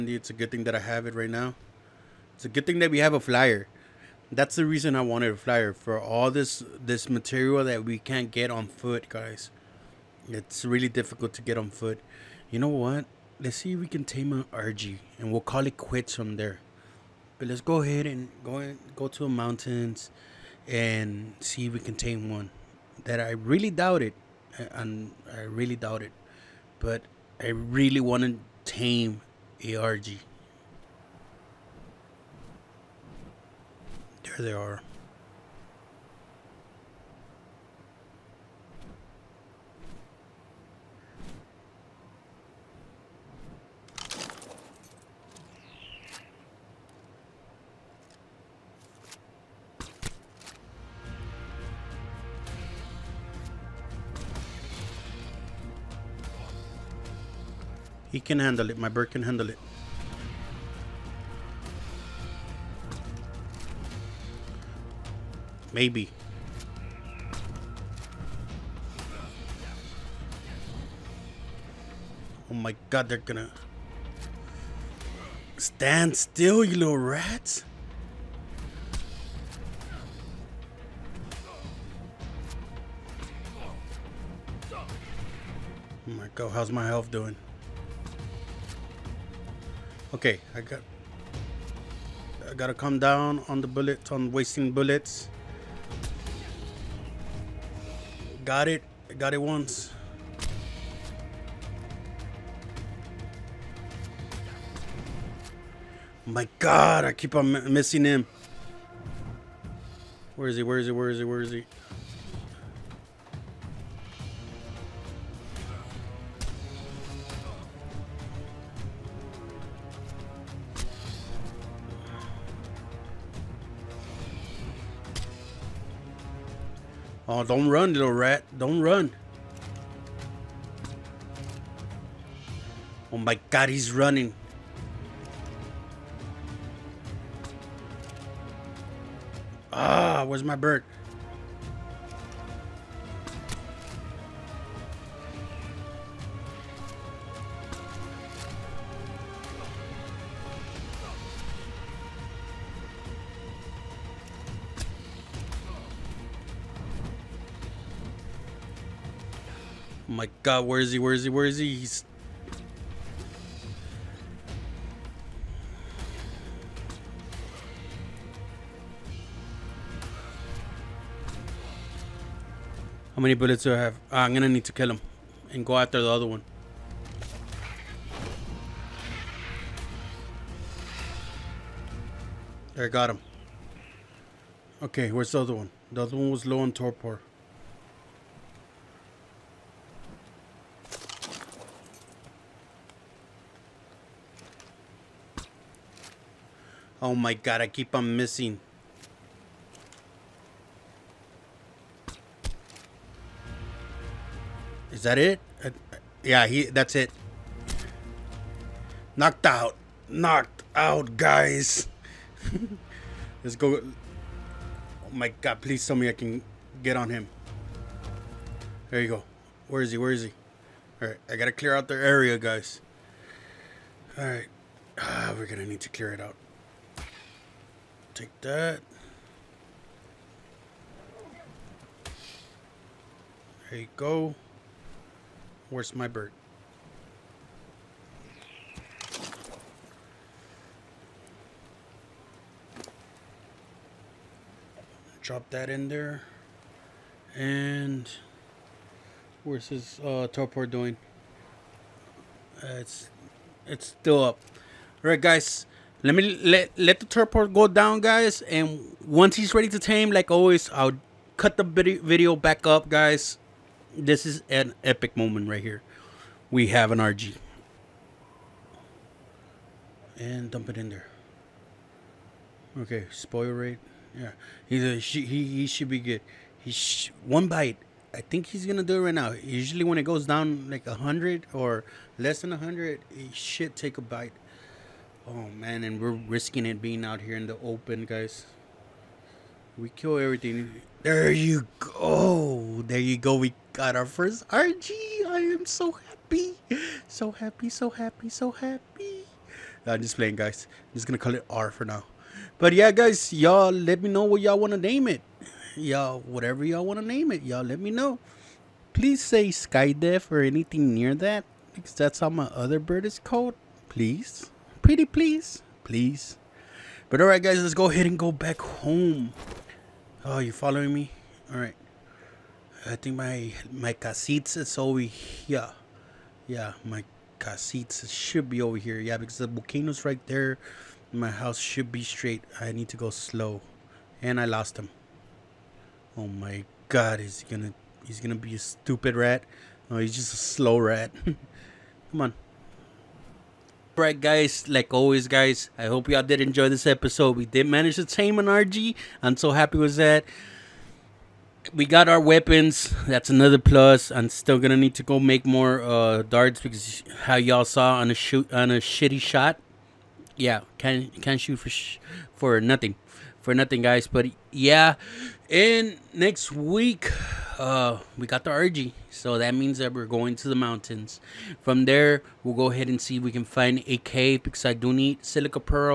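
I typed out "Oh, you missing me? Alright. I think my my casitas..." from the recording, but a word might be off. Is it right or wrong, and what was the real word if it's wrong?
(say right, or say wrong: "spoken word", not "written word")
wrong: "following", not "missing".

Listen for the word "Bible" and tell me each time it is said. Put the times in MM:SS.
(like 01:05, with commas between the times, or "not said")
not said.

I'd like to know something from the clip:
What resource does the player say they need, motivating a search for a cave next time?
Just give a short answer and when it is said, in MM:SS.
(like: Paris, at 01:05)
silica, at 06:15.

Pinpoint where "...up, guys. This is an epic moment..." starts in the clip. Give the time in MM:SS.
04:22.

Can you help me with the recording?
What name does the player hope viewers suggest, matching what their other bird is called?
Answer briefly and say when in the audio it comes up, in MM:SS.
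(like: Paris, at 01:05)
Skydef, at 05:09.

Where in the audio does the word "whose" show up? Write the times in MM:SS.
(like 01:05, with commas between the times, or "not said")
not said.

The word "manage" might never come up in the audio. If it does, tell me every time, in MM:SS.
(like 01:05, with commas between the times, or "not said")
05:47.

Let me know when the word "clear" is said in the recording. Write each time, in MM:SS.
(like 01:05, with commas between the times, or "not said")
03:41, 03:45.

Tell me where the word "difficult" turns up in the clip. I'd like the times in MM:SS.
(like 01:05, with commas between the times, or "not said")
00:10.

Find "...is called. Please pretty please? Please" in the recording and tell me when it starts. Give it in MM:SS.
05:13.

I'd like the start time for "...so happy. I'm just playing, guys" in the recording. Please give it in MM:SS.
04:58.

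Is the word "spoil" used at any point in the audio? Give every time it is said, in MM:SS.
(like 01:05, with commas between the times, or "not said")
04:33.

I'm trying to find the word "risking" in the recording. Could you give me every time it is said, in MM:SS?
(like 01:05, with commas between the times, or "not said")
04:46.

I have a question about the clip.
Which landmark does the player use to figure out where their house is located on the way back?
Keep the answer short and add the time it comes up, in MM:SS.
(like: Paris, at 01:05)
the volcano, at 05:29.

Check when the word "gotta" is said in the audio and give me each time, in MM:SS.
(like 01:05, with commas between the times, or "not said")
01:32, 03:41.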